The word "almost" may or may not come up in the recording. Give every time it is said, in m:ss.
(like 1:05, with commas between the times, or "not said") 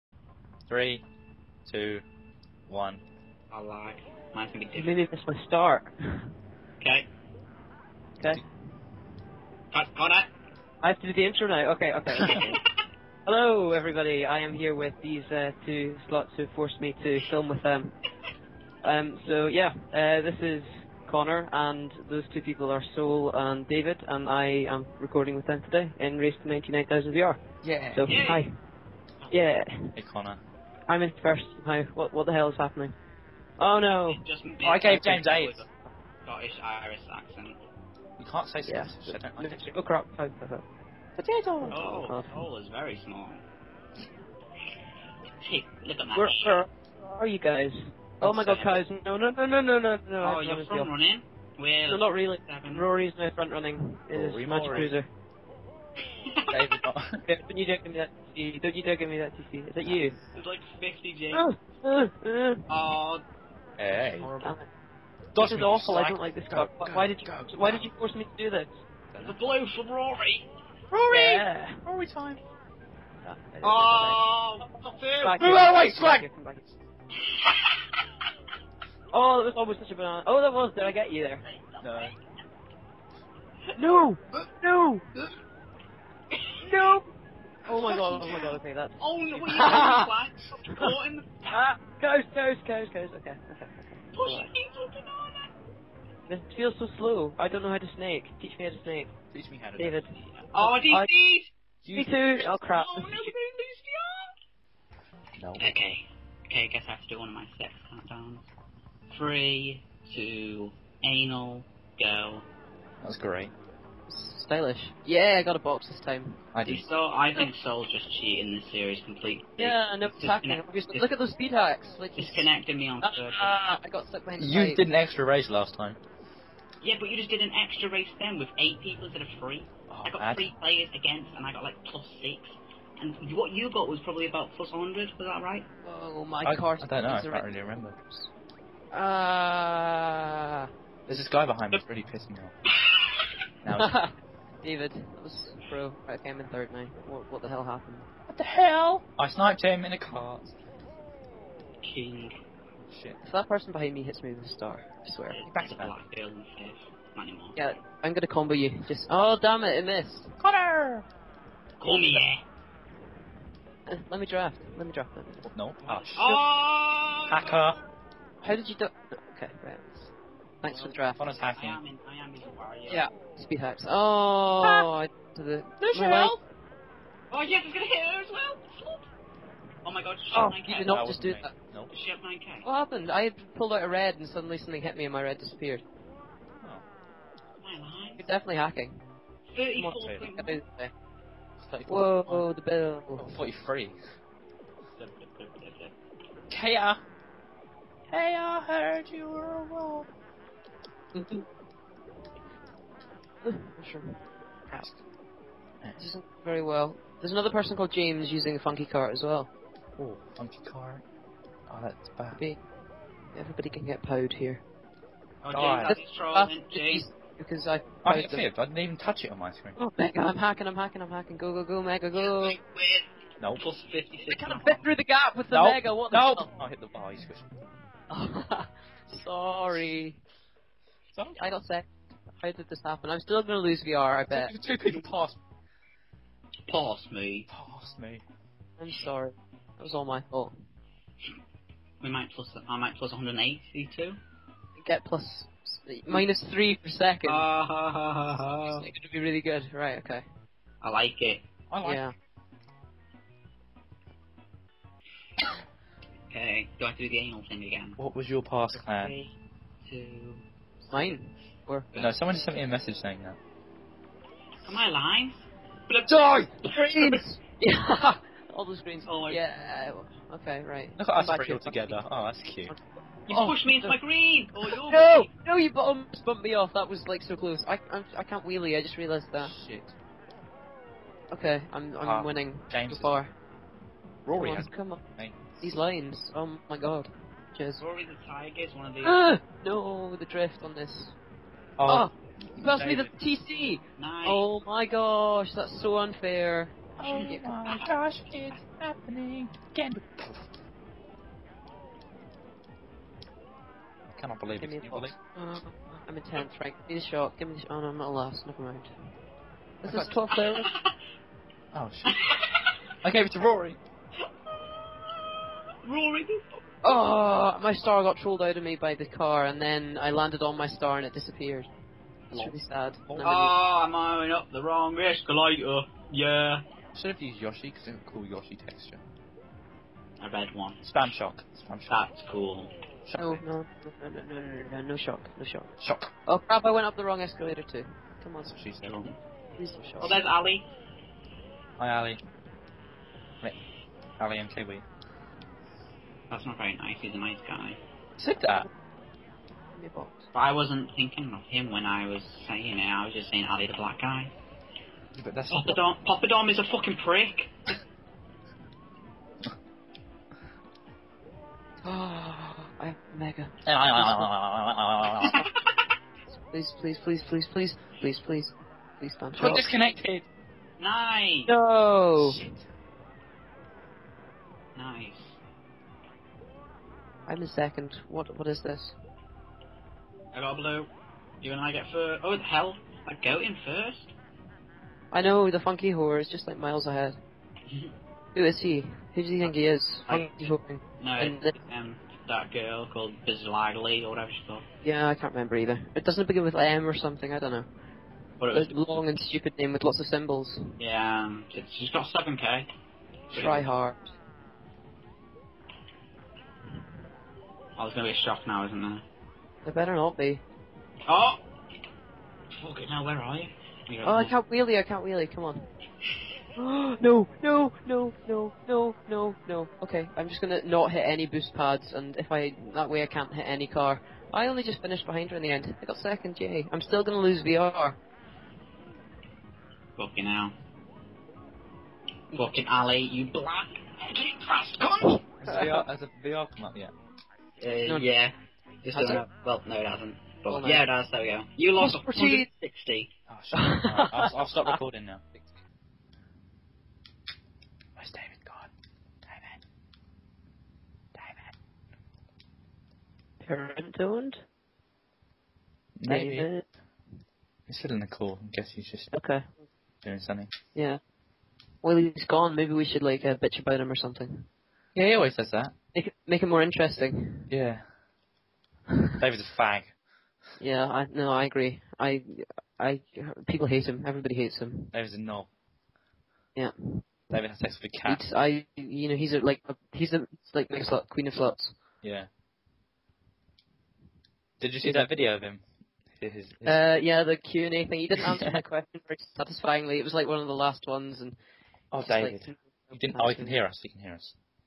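1:19, 4:35.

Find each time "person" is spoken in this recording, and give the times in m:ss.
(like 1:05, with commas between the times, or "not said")
2:33, 3:27.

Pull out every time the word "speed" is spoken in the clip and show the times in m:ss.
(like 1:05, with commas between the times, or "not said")
2:01, 2:53.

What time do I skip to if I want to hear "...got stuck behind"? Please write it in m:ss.
2:03.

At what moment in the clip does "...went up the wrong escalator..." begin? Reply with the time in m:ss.
5:36.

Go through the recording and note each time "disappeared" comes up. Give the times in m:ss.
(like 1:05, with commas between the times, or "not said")
3:05, 5:21.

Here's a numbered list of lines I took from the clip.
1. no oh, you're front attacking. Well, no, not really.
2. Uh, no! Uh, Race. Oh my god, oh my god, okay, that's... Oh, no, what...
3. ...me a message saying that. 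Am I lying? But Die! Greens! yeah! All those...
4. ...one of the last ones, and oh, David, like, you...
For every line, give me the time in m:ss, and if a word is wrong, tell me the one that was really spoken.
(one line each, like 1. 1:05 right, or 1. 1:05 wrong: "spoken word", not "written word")
1. 0:49 wrong: "running", not "attacking"
2. 1:24 wrong: "YouTube", not "Race"
3. 4:22 right
4. 8:10 right.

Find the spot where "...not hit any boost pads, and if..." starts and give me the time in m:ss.
7:00.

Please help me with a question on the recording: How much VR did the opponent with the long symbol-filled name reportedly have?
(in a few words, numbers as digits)
seven K.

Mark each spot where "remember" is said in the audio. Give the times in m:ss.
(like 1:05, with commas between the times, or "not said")
2:17, 6:35.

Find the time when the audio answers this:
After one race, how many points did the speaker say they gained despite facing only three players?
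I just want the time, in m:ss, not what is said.
2:11.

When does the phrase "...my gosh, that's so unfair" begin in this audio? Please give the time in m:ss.
4:54.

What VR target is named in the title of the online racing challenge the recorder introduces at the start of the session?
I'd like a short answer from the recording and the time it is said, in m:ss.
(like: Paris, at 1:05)
99,000, at 0:26.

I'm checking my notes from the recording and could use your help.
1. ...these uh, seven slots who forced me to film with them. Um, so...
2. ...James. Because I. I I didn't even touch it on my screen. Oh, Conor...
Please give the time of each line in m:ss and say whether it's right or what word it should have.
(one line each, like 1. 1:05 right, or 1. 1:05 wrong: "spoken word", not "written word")
1. 0:15 wrong: "two", not "seven"
2. 3:36 wrong: "Mega", not "Conor".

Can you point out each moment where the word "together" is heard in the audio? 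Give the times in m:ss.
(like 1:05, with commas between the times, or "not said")
4:31.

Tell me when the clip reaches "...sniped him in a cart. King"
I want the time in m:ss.
2:29.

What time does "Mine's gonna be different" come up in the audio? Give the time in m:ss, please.
0:04.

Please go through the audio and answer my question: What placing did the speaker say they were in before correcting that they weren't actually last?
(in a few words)
tenth.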